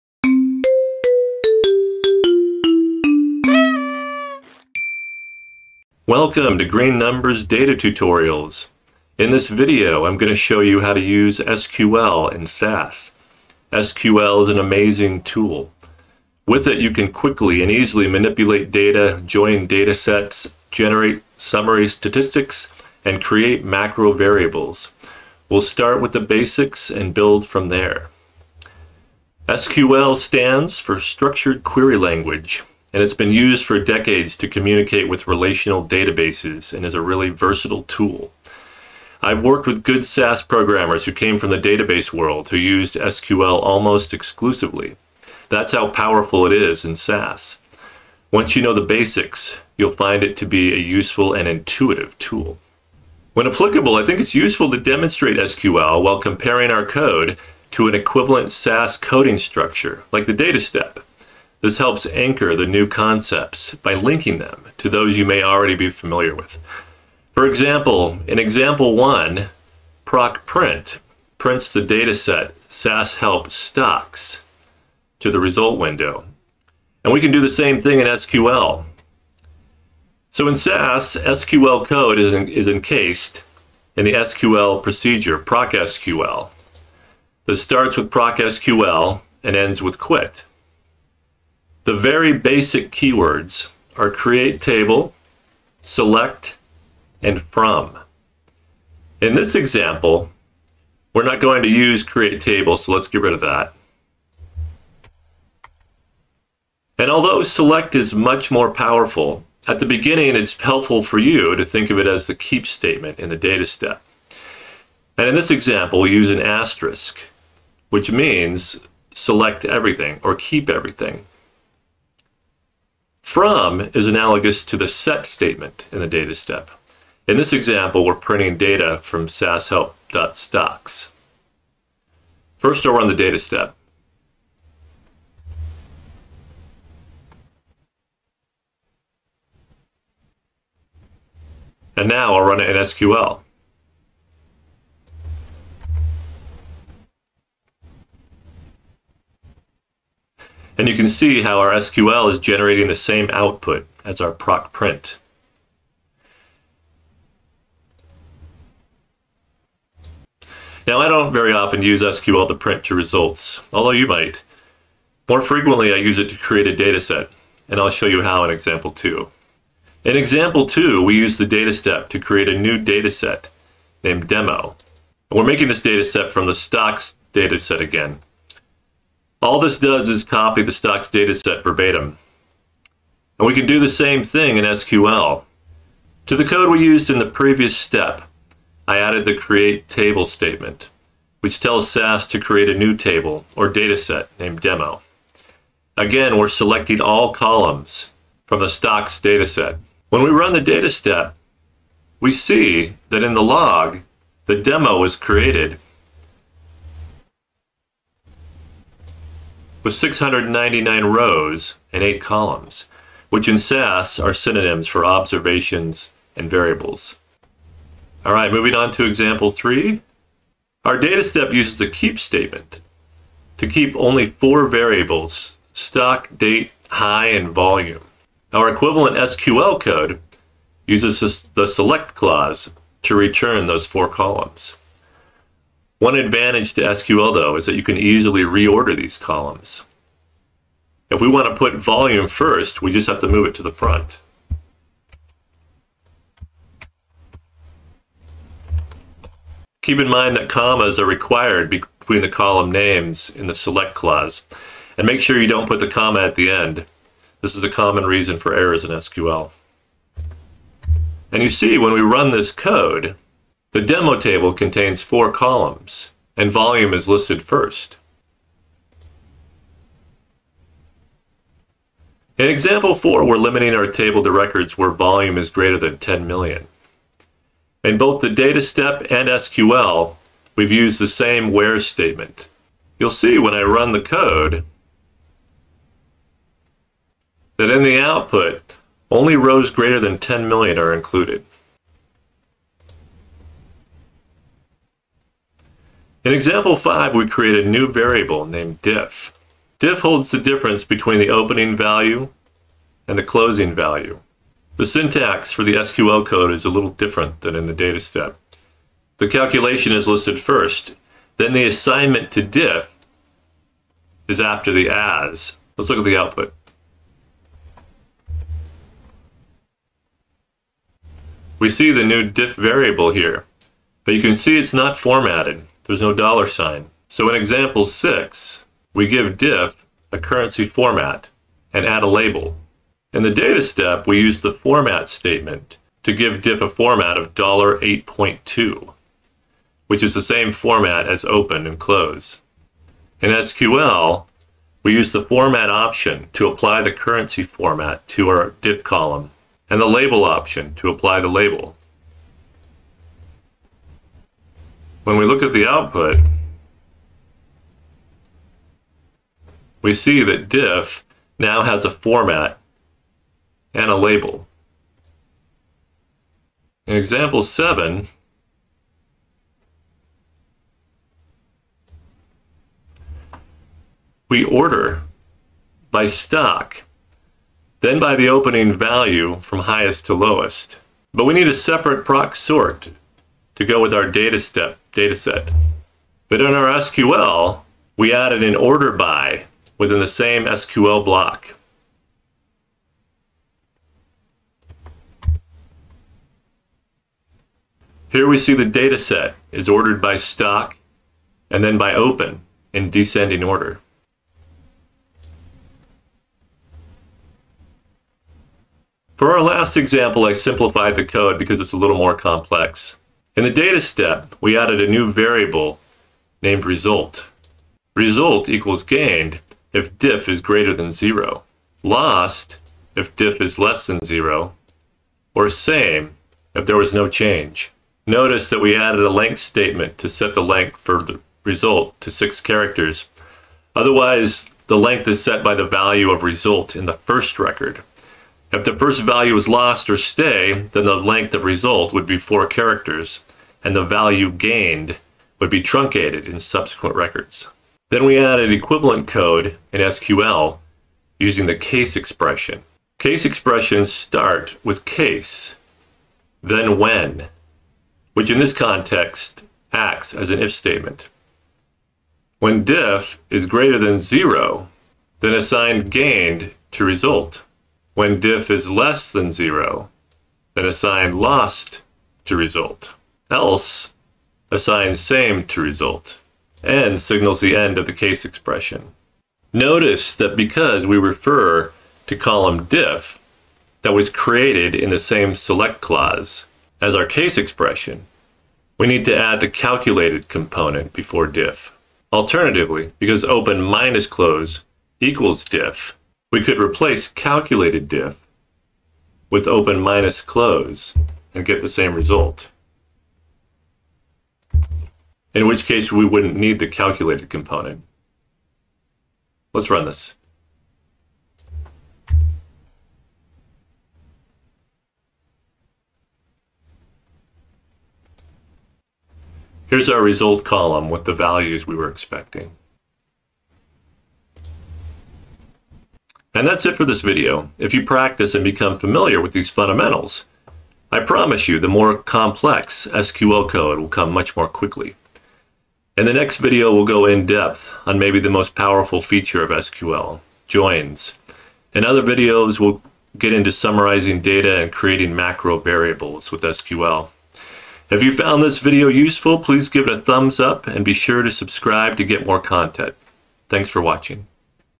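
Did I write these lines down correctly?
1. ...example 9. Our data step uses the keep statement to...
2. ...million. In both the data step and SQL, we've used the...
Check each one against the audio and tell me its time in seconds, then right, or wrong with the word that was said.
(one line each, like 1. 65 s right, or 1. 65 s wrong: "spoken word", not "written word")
1. 219 s wrong: "3", not "9"
2. 276 s right.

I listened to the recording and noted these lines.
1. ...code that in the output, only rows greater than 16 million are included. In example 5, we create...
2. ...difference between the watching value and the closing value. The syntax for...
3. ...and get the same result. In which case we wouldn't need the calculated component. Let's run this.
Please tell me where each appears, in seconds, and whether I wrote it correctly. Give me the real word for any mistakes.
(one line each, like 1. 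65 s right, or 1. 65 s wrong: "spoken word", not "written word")
1. 284 s wrong: "10", not "16"
2. 300 s wrong: "opening", not "watching"
3. 501 s right.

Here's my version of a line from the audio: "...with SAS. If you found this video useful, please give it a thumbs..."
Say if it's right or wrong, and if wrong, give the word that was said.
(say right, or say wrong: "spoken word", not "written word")
wrong: "SQL", not "SAS".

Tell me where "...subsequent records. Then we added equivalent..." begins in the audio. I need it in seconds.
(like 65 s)
446 s.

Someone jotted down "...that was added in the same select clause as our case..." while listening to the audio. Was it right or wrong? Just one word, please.
wrong.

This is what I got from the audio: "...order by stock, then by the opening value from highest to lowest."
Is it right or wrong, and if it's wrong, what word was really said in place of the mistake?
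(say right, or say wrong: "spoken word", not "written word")
right.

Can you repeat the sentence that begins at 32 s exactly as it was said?
And it's been used for decades to communicate with relational databases and is a really versatile tool.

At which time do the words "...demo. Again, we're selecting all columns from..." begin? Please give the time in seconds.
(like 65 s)
194 s.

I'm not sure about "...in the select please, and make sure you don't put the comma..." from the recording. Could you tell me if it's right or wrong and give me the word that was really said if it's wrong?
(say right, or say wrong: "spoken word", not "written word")
wrong: "clause", not "please".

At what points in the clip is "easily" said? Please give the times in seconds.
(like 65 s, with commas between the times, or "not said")
17 s, 237 s.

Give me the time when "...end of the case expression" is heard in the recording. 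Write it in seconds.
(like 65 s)
477 s.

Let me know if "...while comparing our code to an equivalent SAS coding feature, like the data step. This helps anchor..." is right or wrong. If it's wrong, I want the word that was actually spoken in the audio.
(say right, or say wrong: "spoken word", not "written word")
wrong: "structure", not "feature".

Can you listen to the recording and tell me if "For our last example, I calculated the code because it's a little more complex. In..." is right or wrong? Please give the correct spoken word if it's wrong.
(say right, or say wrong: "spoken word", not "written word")
wrong: "simplified", not "calculated".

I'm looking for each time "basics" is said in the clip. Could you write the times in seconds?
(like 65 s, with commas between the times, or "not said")
26 s, 48 s, 92 s.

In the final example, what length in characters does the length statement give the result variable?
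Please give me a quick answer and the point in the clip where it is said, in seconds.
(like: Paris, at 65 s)
6, at 432 s.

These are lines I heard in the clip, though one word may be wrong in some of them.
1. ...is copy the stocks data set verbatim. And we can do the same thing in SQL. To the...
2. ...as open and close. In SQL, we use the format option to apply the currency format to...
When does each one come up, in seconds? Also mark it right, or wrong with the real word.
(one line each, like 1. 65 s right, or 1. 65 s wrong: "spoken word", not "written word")
1. 180 s right
2. 341 s right.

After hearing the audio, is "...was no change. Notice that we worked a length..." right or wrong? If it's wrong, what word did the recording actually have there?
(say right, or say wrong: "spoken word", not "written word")
wrong: "added", not "worked".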